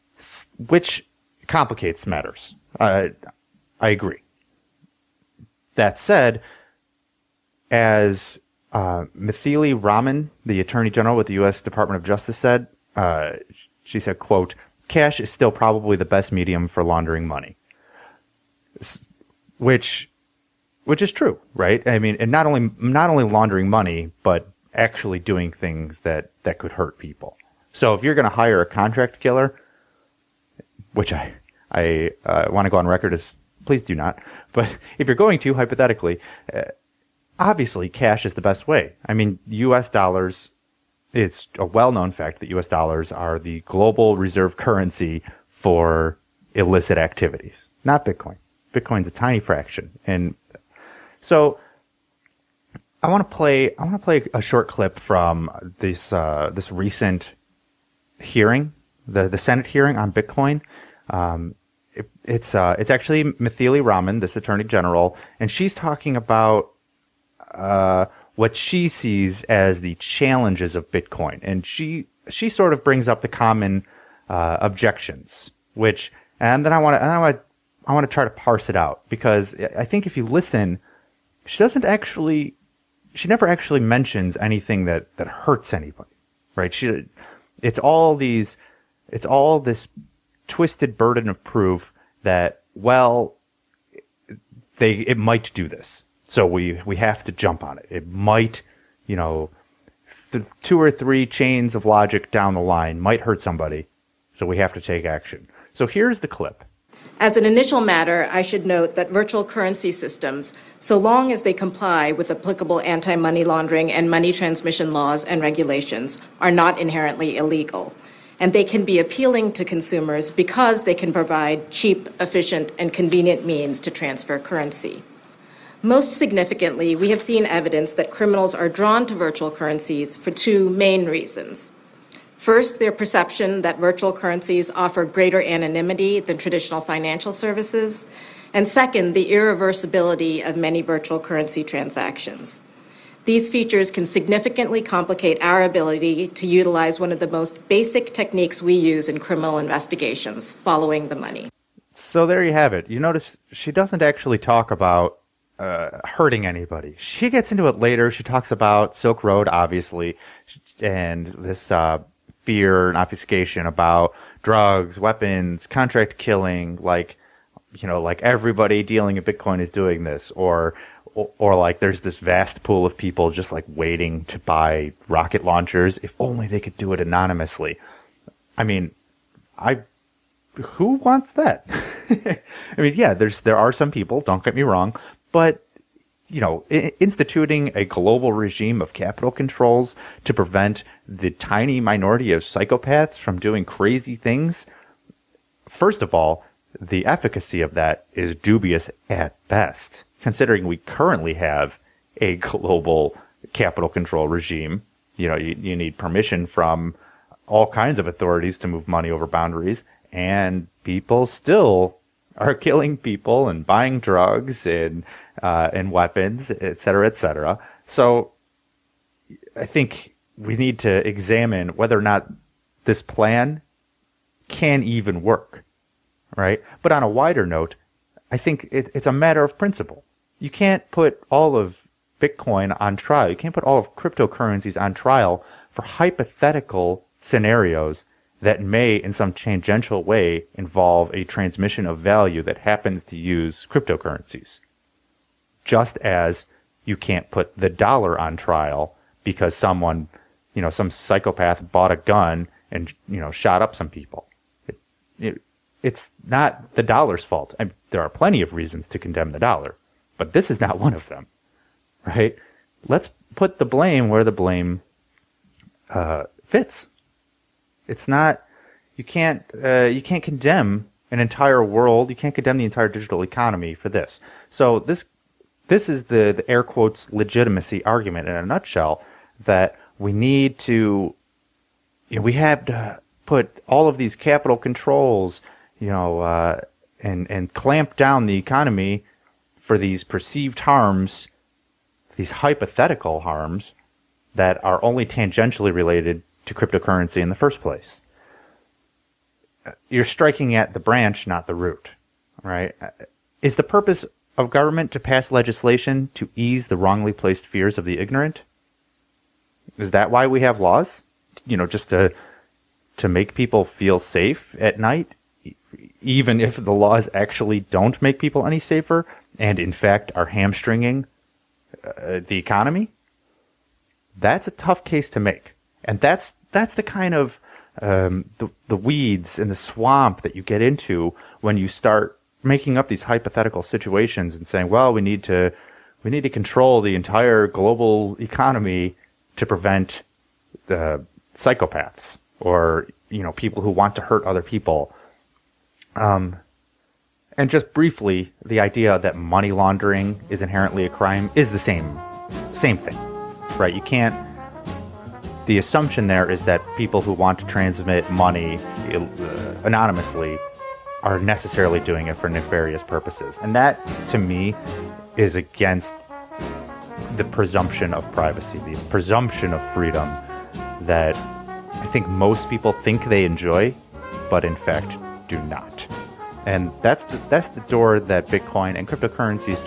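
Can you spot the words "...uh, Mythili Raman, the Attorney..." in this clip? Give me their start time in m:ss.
0:08.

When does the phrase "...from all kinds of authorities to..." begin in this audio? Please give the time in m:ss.
3:26.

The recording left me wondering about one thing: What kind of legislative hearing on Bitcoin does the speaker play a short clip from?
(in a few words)
Senate hearing.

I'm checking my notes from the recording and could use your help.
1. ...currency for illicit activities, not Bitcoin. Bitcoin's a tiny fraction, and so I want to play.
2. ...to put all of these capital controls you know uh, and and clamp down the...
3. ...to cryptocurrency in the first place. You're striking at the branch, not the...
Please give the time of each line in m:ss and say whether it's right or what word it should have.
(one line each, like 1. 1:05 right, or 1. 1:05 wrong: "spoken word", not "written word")
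1. 0:44 right
2. 4:42 right
3. 4:56 right.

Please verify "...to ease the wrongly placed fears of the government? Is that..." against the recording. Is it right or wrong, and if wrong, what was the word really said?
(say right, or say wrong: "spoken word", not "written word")
wrong: "ignorant", not "government".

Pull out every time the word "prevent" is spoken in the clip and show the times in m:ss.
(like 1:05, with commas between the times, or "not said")
3:10, 5:39.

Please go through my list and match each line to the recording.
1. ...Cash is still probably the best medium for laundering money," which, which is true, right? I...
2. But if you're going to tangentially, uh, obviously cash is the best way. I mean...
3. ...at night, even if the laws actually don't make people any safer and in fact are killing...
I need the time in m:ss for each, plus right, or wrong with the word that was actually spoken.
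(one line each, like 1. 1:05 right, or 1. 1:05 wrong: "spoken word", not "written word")
1. 0:14 right
2. 0:34 wrong: "hypothetically", not "tangentially"
3. 5:14 wrong: "hamstringing", not "killing".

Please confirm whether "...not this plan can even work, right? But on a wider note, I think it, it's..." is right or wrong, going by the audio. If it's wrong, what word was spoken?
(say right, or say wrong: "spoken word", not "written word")
right.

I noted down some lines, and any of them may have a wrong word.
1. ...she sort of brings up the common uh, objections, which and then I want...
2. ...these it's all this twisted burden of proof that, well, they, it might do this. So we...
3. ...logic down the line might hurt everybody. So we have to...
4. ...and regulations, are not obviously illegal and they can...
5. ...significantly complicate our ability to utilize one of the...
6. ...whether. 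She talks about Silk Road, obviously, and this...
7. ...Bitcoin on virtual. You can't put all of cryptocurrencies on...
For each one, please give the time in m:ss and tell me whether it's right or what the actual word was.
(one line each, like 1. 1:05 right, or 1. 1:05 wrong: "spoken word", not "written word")
1. 1:12 right
2. 1:28 right
3. 1:41 wrong: "somebody", not "everybody"
4. 1:55 wrong: "inherently", not "obviously"
5. 2:24 right
6. 2:37 wrong: "later", not "whether"
7. 3:52 wrong: "trial", not "virtual".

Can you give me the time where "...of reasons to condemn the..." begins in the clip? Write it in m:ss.
4:18.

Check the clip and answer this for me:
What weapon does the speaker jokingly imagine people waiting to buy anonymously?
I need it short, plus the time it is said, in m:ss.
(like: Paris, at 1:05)
Rocket launchers, at 2:55.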